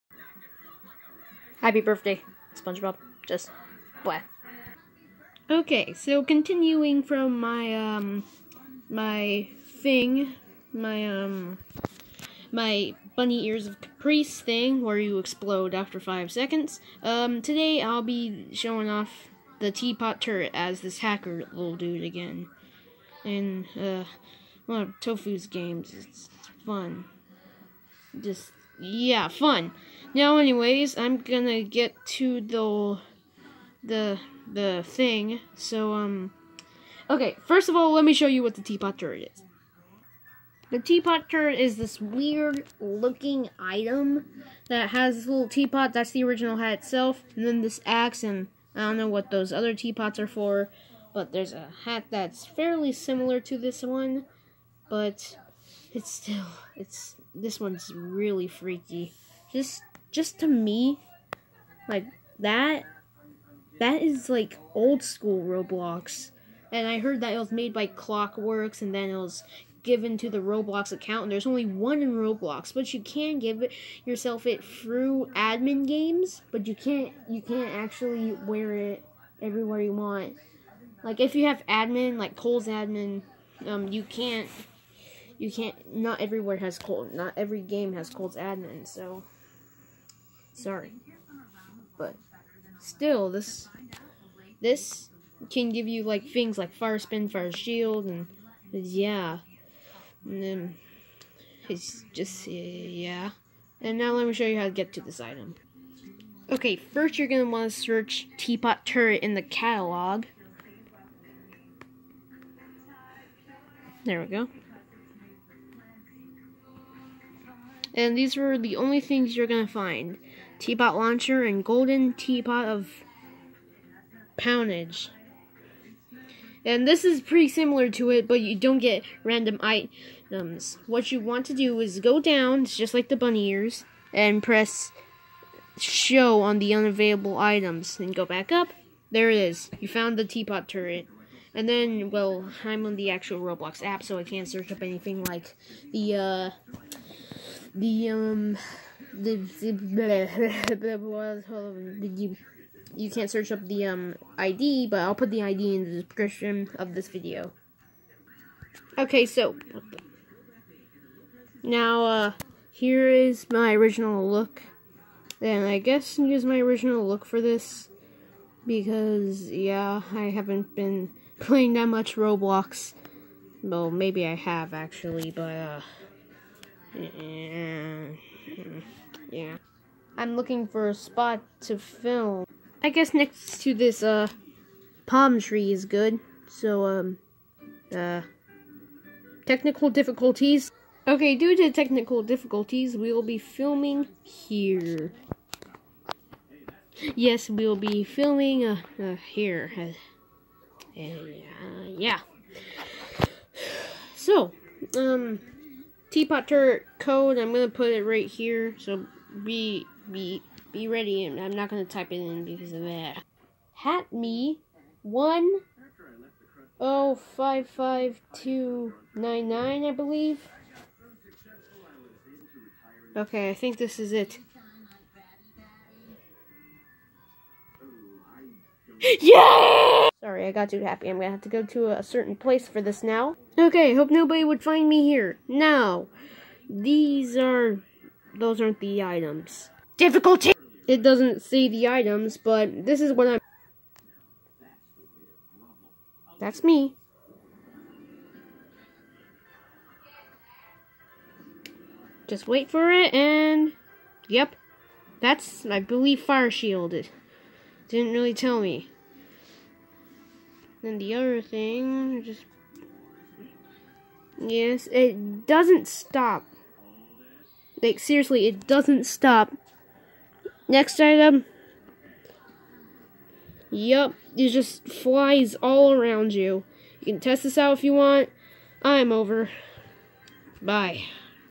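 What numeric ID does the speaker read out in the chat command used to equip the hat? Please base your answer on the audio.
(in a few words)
1055299.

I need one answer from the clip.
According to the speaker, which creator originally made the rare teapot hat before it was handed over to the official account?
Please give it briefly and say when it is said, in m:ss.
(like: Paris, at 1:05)
Clockworks, at 1:07.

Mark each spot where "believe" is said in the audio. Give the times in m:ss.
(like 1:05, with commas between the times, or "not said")
3:39, 4:15.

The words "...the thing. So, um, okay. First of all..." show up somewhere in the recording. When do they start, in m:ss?
0:34.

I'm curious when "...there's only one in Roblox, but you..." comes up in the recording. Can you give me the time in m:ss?
1:11.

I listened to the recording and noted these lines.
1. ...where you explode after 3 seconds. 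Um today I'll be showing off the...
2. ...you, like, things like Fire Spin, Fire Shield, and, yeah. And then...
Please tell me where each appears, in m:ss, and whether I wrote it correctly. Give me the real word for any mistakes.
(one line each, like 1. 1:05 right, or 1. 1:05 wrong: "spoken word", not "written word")
1. 0:14 wrong: "5", not "3"
2. 1:35 right.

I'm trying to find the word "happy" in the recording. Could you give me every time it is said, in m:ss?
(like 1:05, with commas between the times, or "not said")
0:01, 3:50.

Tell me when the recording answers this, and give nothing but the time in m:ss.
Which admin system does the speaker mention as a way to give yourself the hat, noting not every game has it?
1:22.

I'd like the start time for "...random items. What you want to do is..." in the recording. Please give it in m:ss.
2:09.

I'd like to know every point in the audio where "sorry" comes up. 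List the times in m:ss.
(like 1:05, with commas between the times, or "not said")
1:30.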